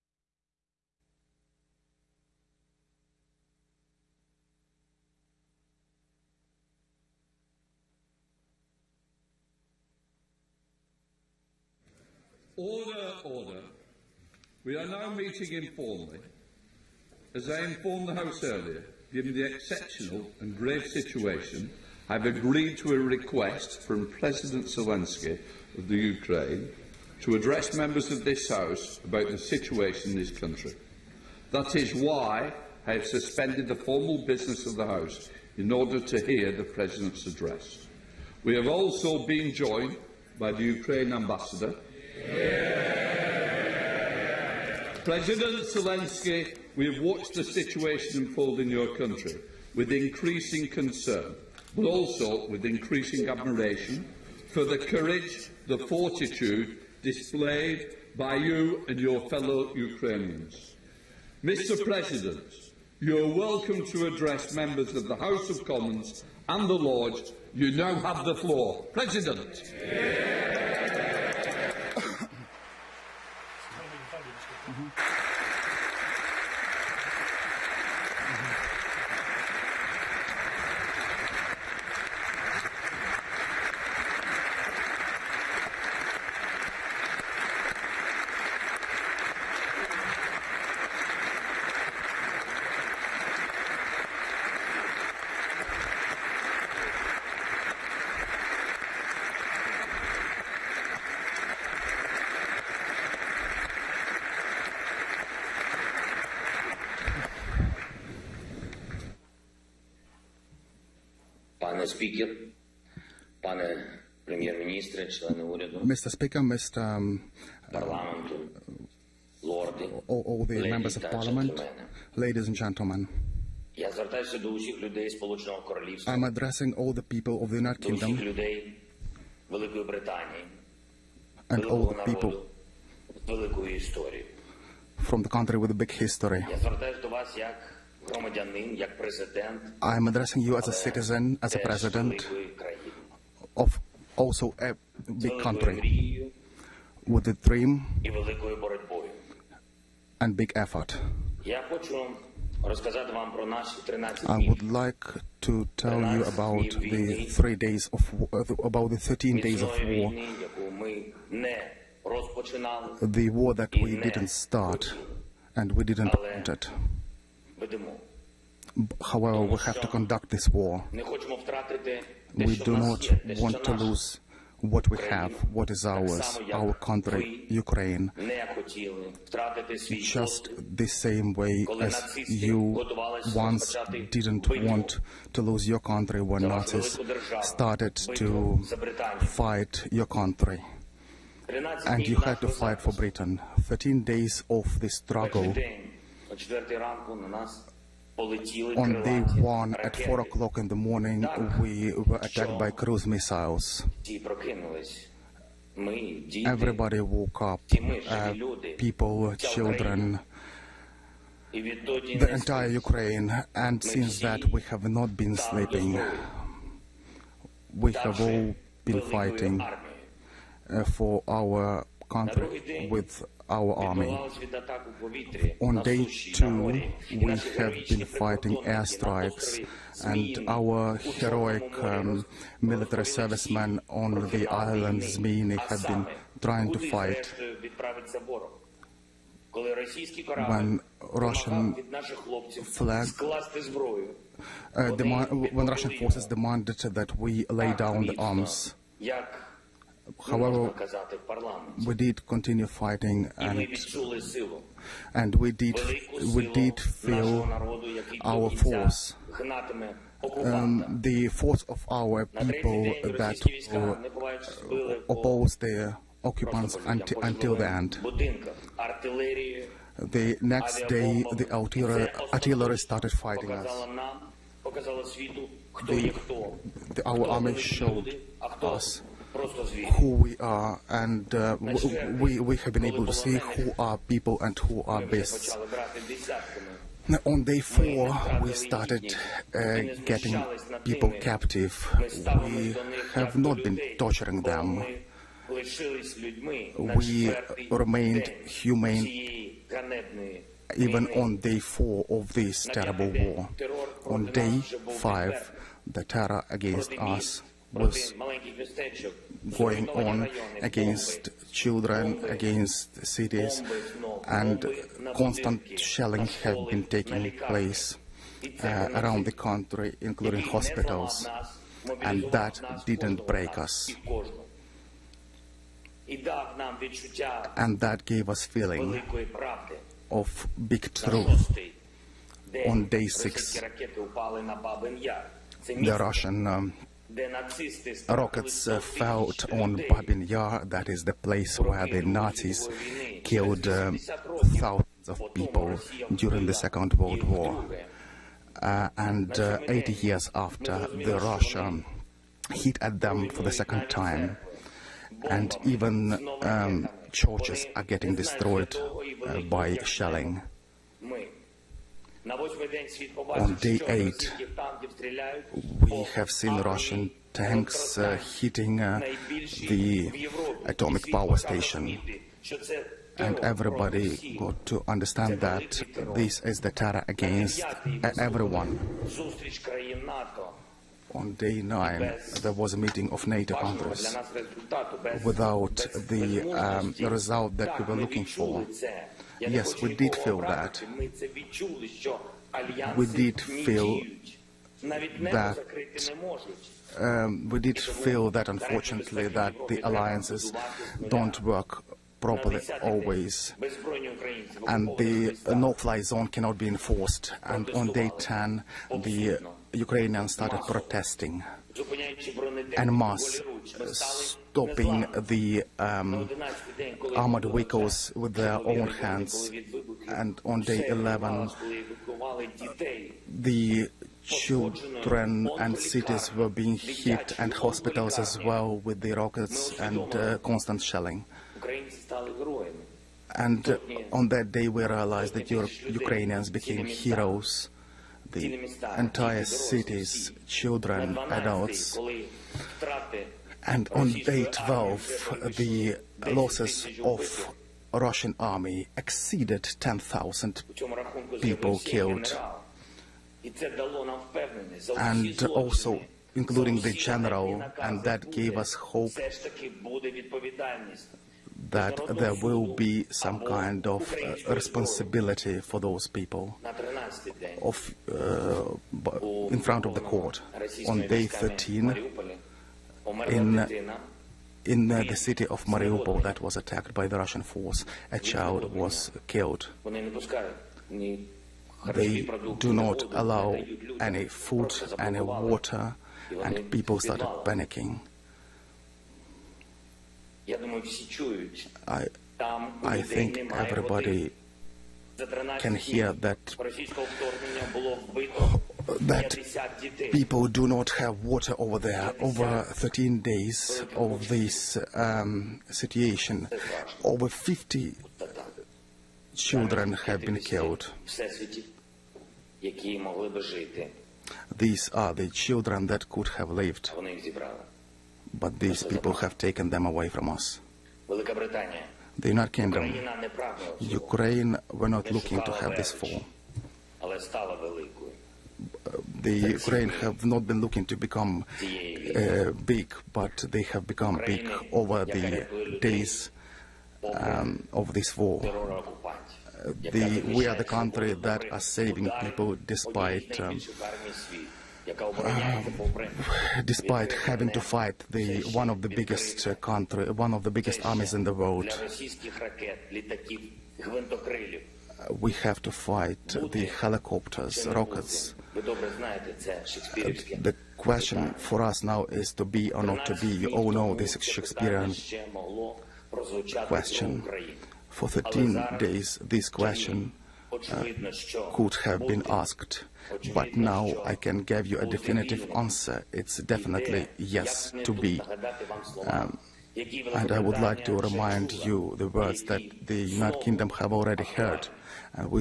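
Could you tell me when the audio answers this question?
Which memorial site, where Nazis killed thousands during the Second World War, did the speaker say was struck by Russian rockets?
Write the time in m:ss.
5:39.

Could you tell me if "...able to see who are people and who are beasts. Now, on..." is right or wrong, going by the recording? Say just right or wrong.
right.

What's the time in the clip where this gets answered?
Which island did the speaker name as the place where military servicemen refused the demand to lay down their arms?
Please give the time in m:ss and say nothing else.
3:55.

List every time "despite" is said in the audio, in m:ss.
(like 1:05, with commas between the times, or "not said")
9:02, 9:06.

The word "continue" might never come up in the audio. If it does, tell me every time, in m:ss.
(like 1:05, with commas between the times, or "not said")
4:12.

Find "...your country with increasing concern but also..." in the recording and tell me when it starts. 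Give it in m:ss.
0:48.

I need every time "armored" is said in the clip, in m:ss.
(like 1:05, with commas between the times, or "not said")
6:57.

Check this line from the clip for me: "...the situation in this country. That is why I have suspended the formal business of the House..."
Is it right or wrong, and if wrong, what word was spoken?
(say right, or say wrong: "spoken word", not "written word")
right.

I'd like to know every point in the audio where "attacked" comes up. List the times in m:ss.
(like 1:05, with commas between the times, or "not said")
3:22, 7:56.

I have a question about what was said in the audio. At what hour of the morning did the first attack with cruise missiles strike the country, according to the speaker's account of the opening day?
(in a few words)
4 o'clock.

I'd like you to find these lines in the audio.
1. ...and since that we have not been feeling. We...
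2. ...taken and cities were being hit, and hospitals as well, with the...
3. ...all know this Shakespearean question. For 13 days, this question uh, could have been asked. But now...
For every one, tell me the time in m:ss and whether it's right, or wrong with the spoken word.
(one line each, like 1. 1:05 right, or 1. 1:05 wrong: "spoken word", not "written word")
1. 3:33 wrong: "sleeping", not "feeling"
2. 7:04 wrong: "children", not "taken"
3. 9:23 right.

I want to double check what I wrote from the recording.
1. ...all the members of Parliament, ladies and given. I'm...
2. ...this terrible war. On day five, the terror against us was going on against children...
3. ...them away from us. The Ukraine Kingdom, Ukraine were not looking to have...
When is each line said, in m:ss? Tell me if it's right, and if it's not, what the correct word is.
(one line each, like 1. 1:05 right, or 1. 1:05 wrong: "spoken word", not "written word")
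1. 2:00 wrong: "gentlemen", not "given"
2. 5:02 right
3. 8:39 wrong: "United", not "Ukraine".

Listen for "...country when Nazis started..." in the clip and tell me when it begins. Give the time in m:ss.
3:05.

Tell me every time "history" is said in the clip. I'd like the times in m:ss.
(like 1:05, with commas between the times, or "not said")
2:15.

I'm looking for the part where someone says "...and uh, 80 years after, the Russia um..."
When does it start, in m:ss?
5:48.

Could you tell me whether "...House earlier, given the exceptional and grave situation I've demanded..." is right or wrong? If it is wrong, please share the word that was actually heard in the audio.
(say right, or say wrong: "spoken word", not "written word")
wrong: "agreed", not "demanded".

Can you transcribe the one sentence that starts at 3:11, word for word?
And you had to fight for Britain.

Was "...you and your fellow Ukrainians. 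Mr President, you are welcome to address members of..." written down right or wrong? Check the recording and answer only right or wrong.
right.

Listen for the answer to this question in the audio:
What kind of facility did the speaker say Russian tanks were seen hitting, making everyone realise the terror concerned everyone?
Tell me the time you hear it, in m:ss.
6:10.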